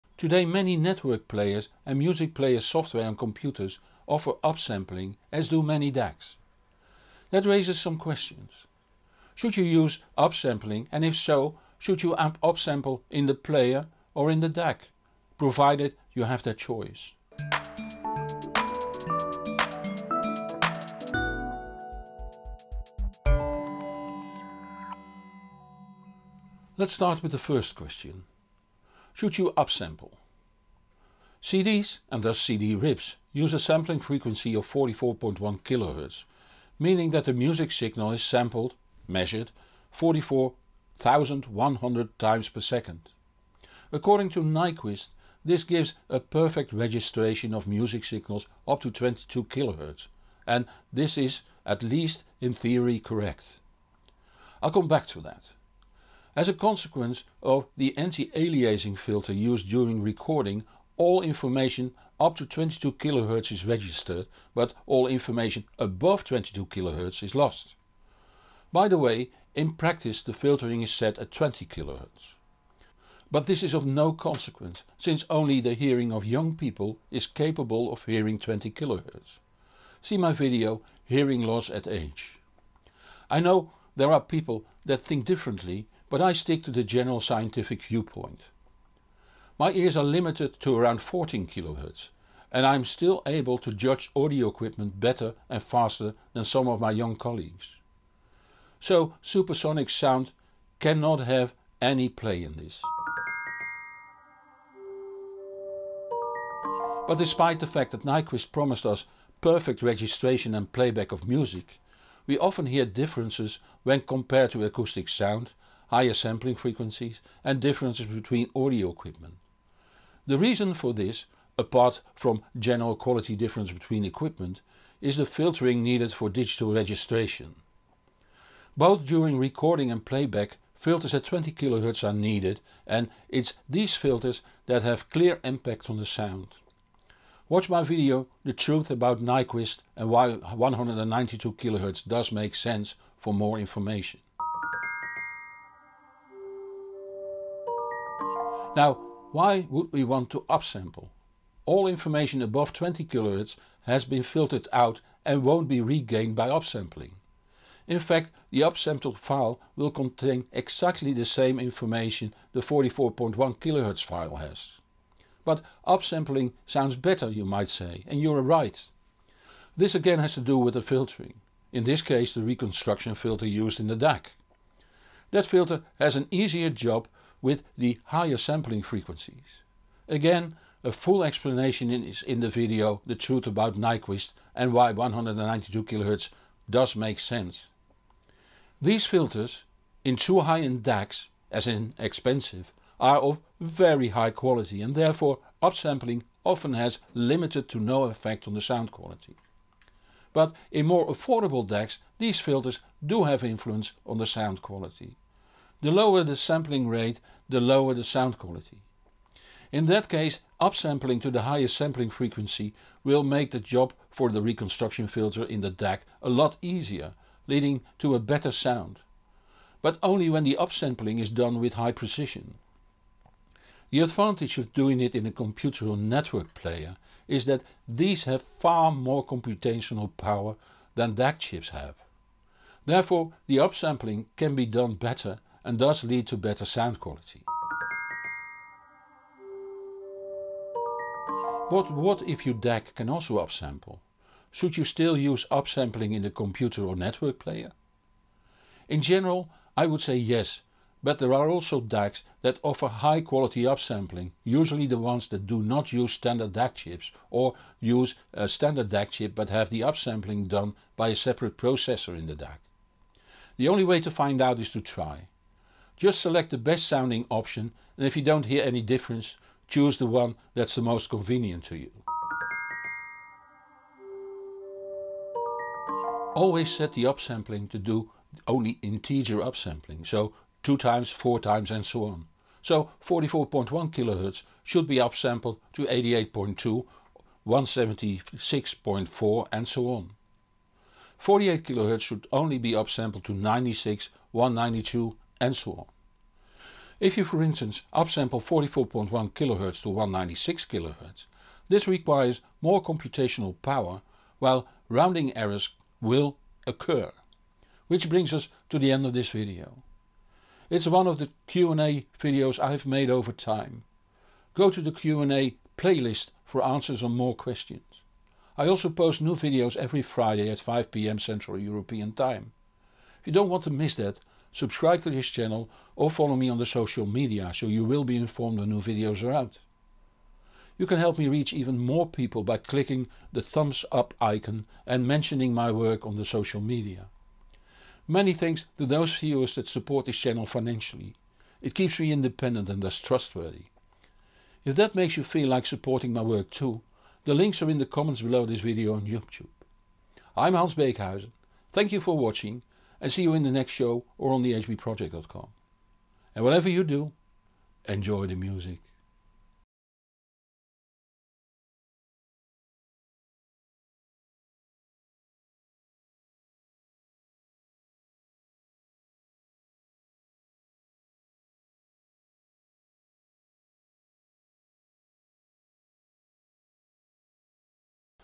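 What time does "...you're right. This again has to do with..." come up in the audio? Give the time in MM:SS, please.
02:48.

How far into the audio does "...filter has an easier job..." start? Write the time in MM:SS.
02:55.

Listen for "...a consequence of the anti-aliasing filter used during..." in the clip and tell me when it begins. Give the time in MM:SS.
00:56.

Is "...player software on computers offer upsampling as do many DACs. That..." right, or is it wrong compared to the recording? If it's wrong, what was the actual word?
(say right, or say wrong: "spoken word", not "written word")
right.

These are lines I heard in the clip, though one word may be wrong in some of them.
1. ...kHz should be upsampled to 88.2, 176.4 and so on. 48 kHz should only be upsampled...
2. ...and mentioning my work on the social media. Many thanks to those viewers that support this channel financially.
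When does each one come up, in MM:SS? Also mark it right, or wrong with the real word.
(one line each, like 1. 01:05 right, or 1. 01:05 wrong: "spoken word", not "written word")
1. 04:43 right
2. 05:34 right.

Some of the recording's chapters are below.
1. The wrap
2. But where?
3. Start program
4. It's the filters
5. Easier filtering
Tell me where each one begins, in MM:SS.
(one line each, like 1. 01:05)
1. 04:34
2. 03:59
3. 00:26
4. 01:44
5. 02:26.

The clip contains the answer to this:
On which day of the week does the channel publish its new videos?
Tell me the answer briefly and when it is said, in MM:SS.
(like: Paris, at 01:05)
Friday, at 05:20.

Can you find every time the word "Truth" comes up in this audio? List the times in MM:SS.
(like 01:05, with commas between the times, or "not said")
02:18, 03:03.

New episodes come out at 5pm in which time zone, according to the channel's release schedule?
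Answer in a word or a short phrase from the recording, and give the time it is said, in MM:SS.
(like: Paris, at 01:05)
Central European Time, at 05:21.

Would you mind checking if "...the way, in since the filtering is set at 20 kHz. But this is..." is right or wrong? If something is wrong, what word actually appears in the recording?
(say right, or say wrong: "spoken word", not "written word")
wrong: "practice", not "since".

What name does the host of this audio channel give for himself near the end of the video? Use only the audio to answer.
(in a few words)
Hans Beekhuyzen.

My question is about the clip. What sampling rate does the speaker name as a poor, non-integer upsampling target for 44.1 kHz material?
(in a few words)
196 kHz.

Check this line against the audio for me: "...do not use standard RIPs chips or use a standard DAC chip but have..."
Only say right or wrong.
wrong.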